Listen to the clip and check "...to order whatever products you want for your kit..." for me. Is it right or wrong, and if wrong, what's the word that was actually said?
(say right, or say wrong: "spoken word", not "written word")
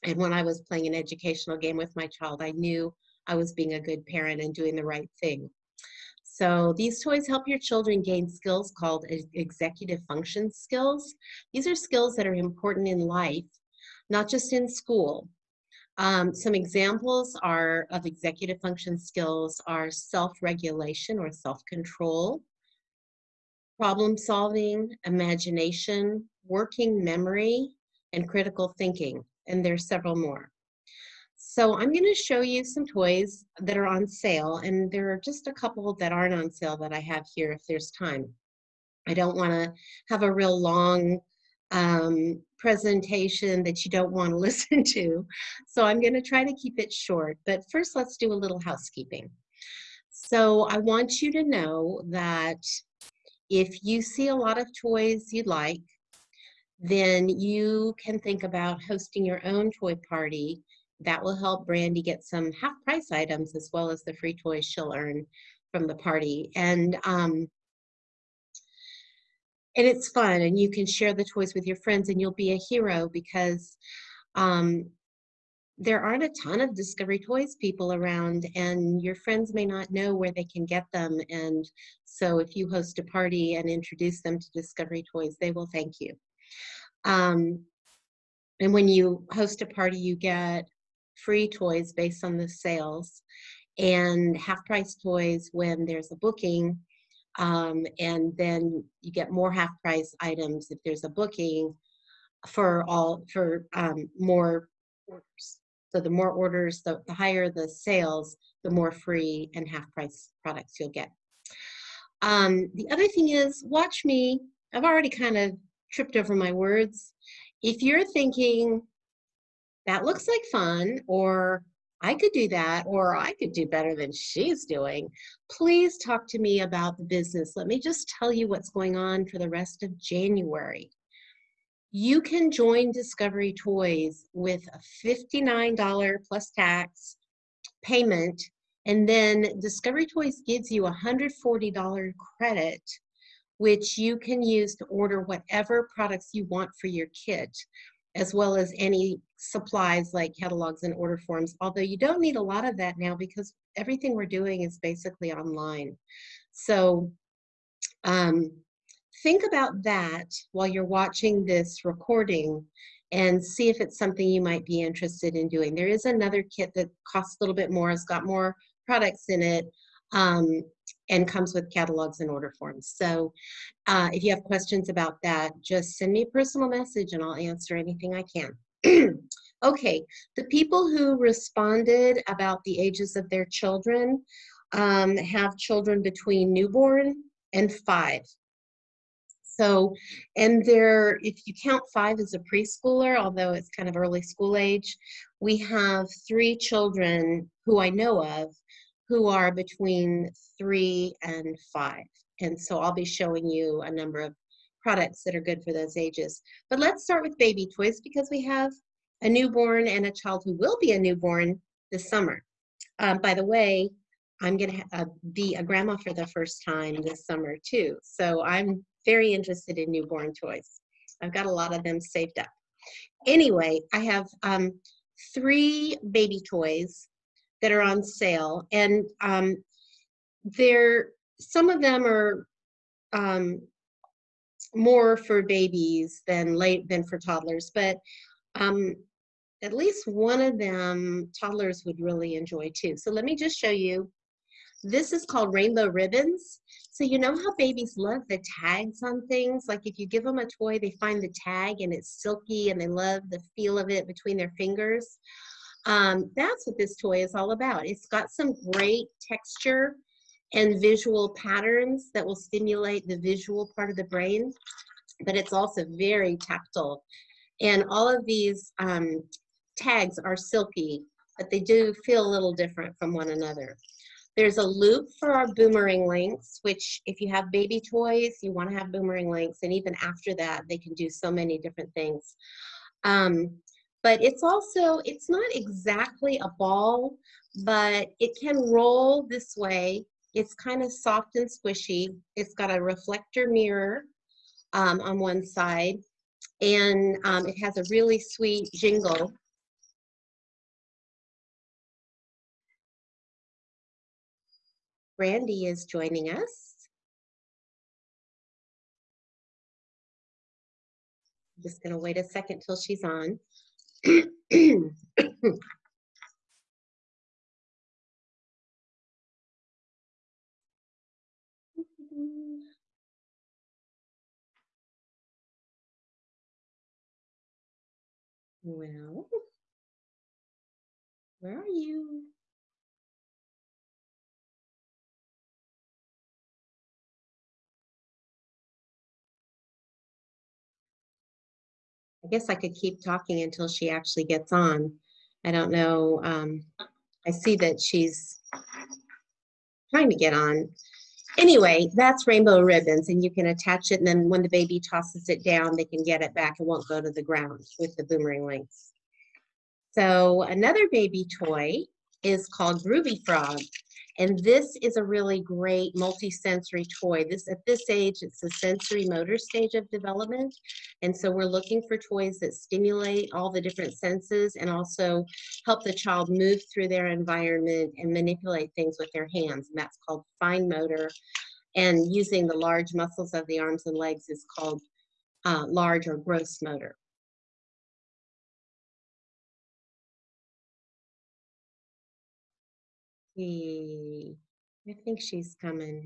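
right.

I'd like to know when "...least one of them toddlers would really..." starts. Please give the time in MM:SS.
03:59.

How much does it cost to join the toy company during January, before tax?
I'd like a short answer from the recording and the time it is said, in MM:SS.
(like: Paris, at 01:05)
$59, at 02:15.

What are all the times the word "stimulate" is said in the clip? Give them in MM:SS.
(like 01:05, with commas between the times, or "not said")
04:22, 06:12.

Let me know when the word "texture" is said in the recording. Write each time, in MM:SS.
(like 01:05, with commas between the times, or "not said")
04:19.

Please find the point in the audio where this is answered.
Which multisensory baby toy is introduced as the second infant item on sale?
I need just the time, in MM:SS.
06:02.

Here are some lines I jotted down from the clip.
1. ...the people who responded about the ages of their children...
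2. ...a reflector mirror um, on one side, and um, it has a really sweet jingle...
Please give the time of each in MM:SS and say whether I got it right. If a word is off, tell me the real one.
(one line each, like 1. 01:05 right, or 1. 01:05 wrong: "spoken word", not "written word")
1. 03:00 right
2. 04:52 right.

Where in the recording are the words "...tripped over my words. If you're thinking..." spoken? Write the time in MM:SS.
01:55.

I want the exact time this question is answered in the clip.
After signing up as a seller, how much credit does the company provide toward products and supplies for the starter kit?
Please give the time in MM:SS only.
02:21.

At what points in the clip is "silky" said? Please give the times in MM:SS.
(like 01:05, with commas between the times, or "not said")
04:12, 04:30.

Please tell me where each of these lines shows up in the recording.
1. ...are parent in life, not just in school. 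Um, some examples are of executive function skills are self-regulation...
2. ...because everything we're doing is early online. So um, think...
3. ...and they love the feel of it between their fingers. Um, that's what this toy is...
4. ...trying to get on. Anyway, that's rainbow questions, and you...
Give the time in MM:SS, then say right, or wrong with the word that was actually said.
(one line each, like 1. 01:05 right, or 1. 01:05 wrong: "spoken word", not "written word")
1. 00:12 wrong: "important", not "parent"
2. 02:33 wrong: "basically", not "early"
3. 04:12 right
4. 05:49 wrong: "ribbons", not "questions".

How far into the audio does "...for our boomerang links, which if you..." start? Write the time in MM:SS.
04:35.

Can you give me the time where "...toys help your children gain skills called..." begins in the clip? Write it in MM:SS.
00:07.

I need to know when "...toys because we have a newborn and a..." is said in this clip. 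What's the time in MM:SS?
03:27.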